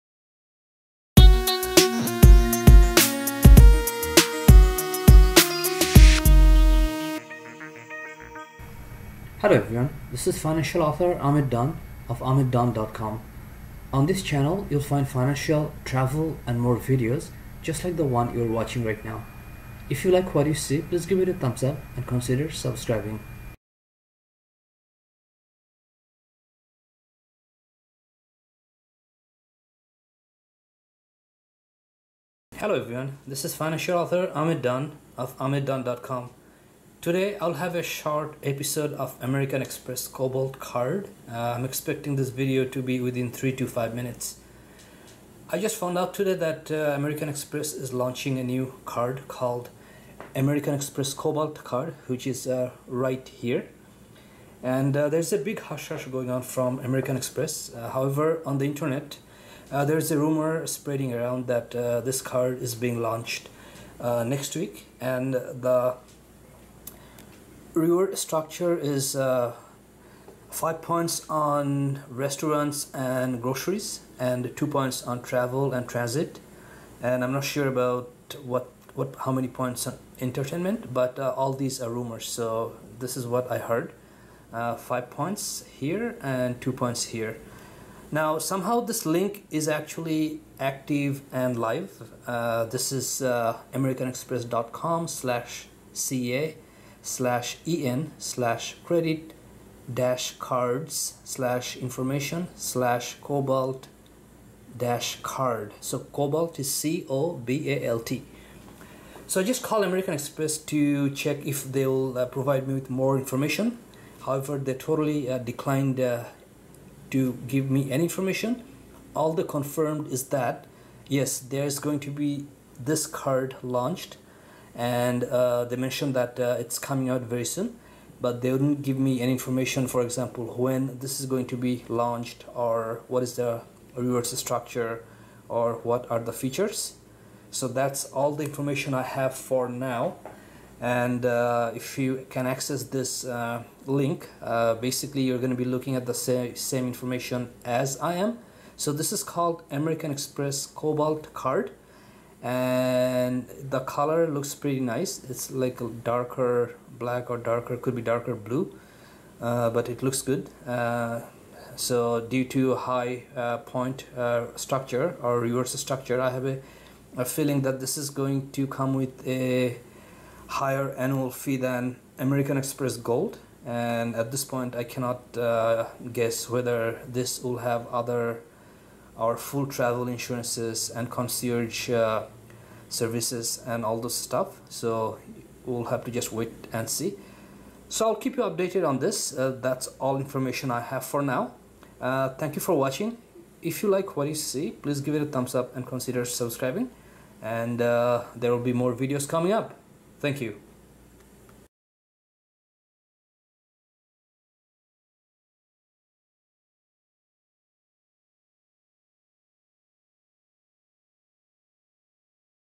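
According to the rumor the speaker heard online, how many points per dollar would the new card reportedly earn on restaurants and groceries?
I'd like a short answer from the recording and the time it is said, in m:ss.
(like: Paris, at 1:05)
5, at 1:10.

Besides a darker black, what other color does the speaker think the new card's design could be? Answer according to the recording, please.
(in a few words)
darker blue.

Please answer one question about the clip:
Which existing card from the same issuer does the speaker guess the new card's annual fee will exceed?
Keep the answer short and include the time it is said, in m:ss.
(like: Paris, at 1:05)
American Express Gold, at 2:52.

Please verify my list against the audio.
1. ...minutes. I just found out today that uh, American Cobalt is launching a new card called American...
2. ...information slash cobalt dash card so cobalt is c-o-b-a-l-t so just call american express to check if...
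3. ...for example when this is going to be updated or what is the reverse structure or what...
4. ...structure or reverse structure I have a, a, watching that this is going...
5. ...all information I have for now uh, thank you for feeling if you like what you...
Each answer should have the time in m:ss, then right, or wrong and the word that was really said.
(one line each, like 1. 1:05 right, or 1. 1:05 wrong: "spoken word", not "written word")
1. 0:43 wrong: "Express", not "Cobalt"
2. 1:41 right
3. 2:09 wrong: "launched", not "updated"
4. 2:44 wrong: "feeling", not "watching"
5. 3:09 wrong: "watching", not "feeling".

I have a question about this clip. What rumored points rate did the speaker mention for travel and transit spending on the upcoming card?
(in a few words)
2.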